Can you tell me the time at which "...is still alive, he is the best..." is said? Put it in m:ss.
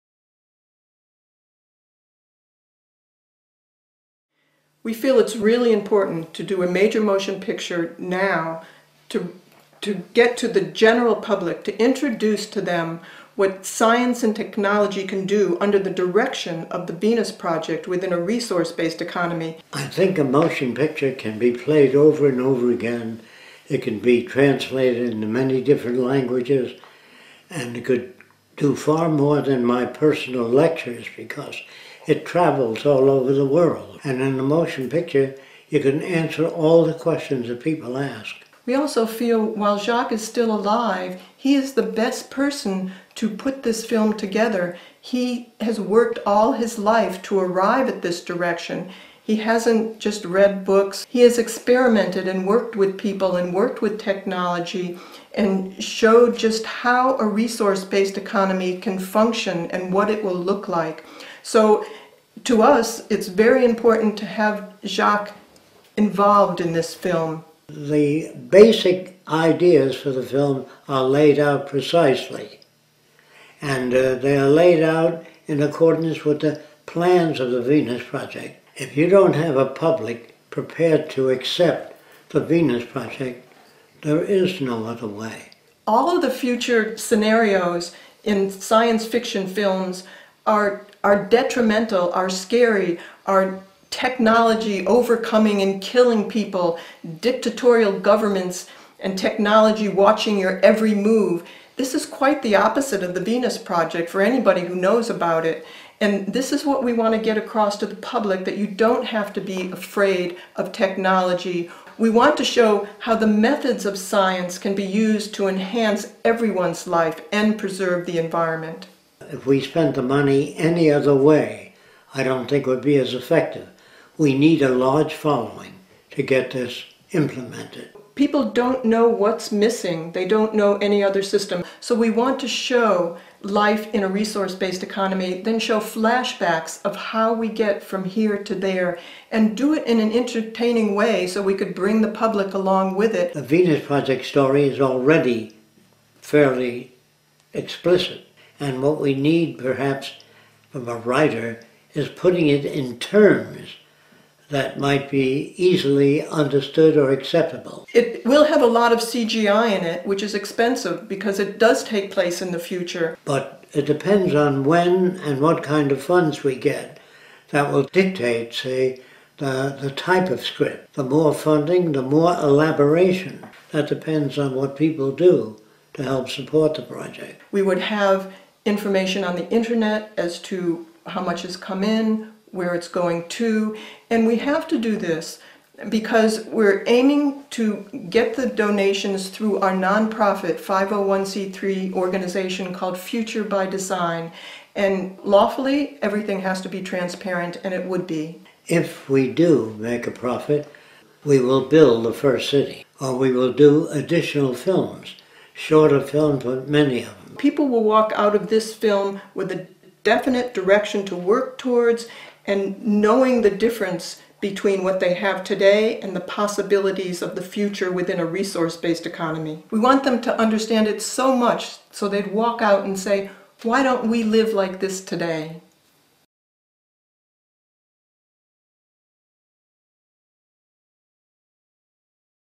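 0:40.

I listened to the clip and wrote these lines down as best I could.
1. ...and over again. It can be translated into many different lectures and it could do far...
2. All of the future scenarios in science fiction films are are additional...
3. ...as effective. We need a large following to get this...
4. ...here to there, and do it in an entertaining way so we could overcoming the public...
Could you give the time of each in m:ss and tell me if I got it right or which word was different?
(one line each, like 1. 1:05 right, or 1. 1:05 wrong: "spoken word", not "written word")
1. 0:22 wrong: "languages", not "lectures"
2. 1:25 wrong: "detrimental", not "additional"
3. 2:02 right
4. 2:18 wrong: "bring", not "overcoming".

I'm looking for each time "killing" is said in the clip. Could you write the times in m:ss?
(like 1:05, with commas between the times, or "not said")
1:35.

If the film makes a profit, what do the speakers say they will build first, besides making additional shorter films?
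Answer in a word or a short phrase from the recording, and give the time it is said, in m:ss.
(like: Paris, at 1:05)
the first city, at 3:22.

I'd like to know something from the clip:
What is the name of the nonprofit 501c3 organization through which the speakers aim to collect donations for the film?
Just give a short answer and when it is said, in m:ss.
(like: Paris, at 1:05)
Future by Design, at 3:12.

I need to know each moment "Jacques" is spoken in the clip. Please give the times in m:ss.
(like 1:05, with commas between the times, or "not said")
0:39, 1:04.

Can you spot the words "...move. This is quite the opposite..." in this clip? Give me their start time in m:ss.
1:40.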